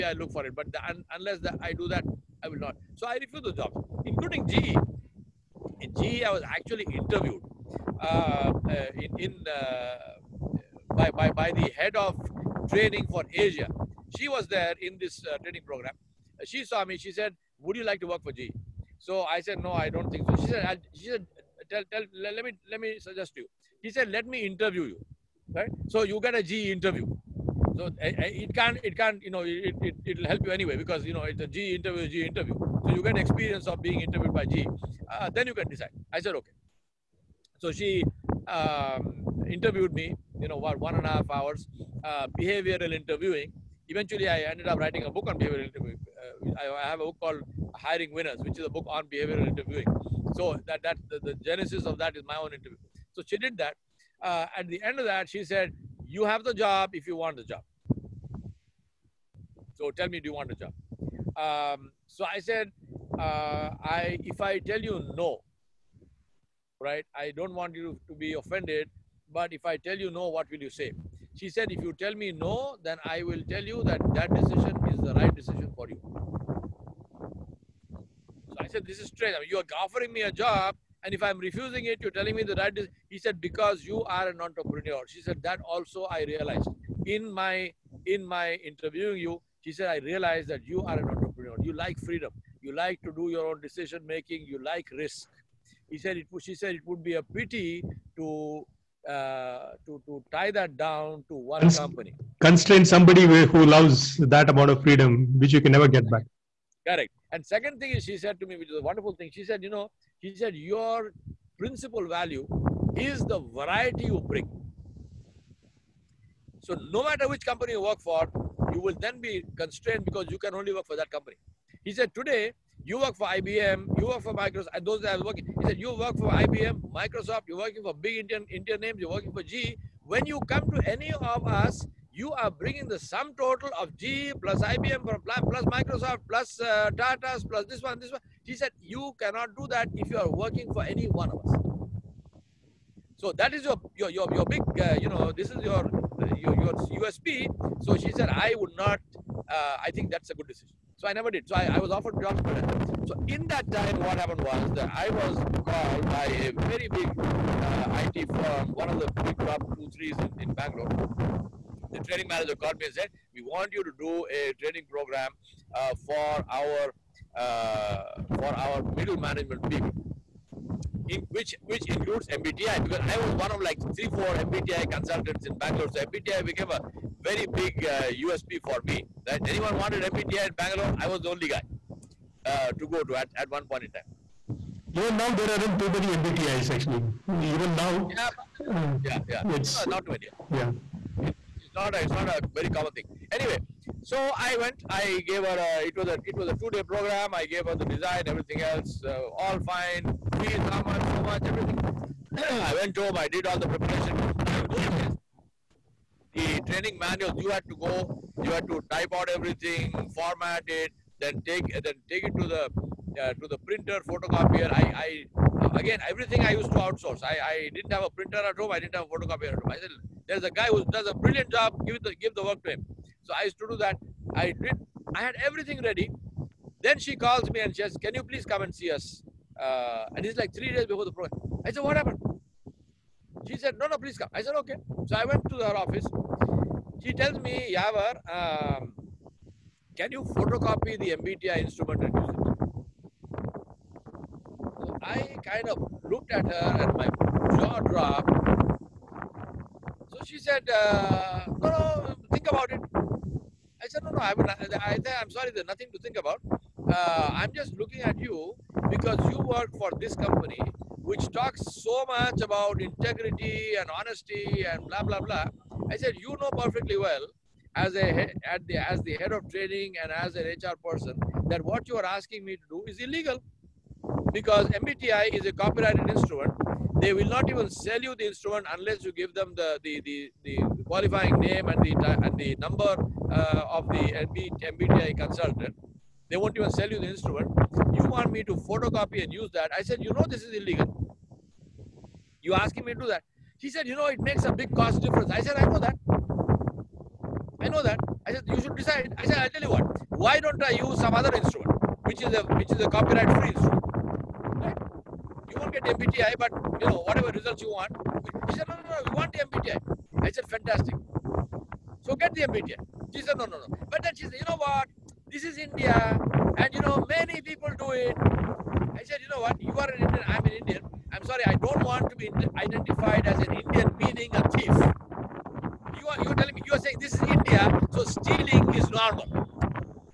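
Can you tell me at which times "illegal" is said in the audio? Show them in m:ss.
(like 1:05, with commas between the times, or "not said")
4:32, 4:50.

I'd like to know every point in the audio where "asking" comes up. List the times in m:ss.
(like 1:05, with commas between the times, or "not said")
4:32, 4:52.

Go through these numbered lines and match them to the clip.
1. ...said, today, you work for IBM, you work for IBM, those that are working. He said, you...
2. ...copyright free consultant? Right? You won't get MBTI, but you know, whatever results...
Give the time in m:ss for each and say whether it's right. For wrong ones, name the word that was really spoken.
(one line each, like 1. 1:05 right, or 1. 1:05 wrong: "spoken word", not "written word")
1. 2:01 wrong: "Microsoft", not "IBM"
2. 5:02 wrong: "instrument", not "consultant".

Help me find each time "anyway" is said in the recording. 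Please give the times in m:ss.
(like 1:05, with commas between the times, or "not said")
0:30, 3:13.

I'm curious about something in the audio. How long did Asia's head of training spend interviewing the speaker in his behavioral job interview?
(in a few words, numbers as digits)
one and a half hours.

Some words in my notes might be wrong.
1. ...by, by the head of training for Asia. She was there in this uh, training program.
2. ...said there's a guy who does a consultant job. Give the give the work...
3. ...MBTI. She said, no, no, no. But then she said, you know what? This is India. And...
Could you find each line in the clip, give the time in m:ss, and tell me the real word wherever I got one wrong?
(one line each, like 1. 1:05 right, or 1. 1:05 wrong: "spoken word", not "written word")
1. 0:11 right
2. 3:39 wrong: "brilliant", not "consultant"
3. 5:12 right.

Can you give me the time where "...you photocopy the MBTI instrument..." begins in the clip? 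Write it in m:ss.
4:00.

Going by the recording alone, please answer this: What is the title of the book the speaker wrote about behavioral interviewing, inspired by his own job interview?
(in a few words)
Hiring Winners.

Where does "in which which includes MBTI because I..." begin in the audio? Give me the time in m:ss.
2:51.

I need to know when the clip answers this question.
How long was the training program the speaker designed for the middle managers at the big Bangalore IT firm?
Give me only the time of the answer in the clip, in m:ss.
3:16.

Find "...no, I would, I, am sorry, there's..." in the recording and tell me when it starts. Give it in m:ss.
4:14.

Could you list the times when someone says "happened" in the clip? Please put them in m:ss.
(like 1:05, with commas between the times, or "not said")
2:34, 3:51.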